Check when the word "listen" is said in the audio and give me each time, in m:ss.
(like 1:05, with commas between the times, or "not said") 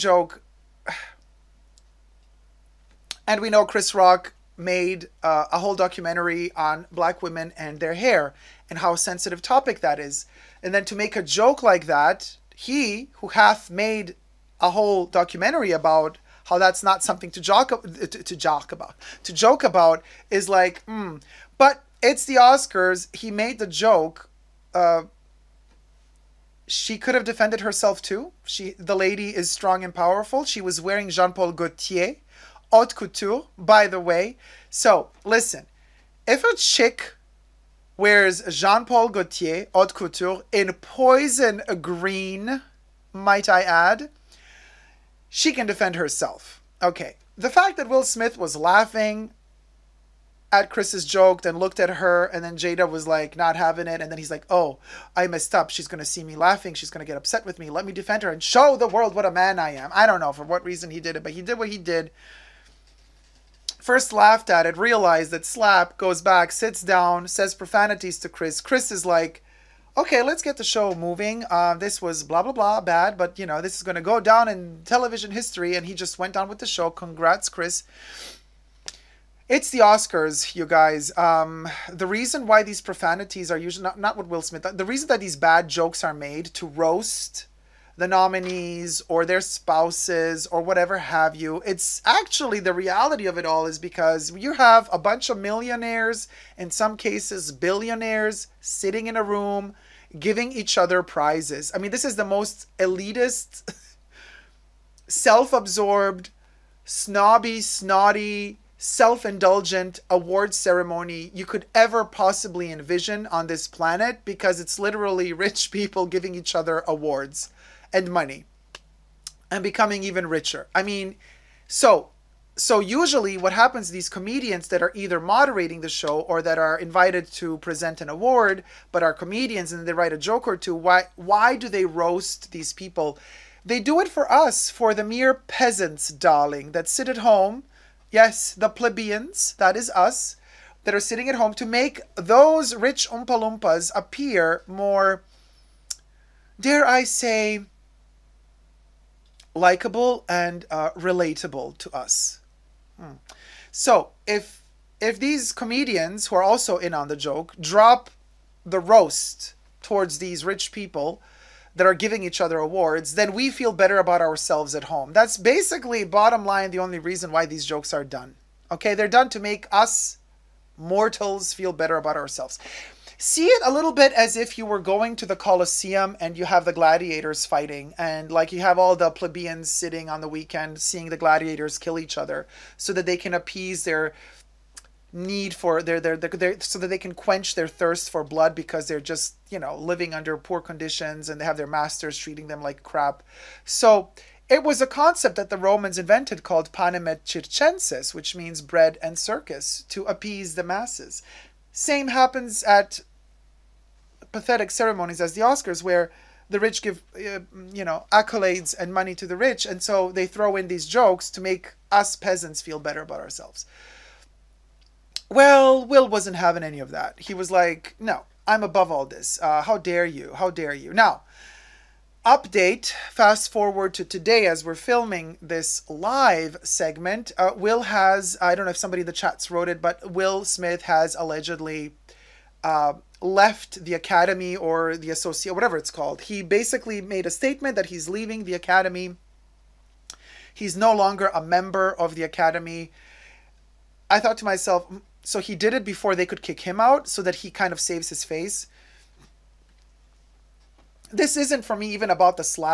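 0:35.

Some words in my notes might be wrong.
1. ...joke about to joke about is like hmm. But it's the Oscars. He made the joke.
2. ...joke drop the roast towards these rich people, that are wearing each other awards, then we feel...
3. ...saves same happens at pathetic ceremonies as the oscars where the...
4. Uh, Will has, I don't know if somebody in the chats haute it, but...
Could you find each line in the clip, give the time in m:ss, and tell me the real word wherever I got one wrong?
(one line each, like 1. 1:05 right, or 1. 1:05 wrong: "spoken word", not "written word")
1. 0:18 right
2. 2:37 wrong: "giving", not "wearing"
3. 3:20 wrong: "masses", not "saves"
4. 3:47 wrong: "wrote", not "haute".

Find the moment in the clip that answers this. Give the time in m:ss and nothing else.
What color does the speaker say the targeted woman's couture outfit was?
0:40.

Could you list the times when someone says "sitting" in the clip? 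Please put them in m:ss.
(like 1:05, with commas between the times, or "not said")
1:38, 2:20, 2:59.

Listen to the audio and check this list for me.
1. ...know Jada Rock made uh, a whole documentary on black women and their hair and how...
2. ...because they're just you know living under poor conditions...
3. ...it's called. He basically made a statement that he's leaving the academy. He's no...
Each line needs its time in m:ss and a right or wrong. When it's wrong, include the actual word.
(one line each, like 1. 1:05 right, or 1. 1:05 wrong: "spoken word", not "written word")
1. 0:03 wrong: "Chris", not "Jada"
2. 3:08 right
3. 3:55 right.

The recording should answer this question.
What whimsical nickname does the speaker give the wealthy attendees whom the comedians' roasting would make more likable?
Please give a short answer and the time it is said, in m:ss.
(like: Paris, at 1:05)
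Oompa Loompas, at 2:23.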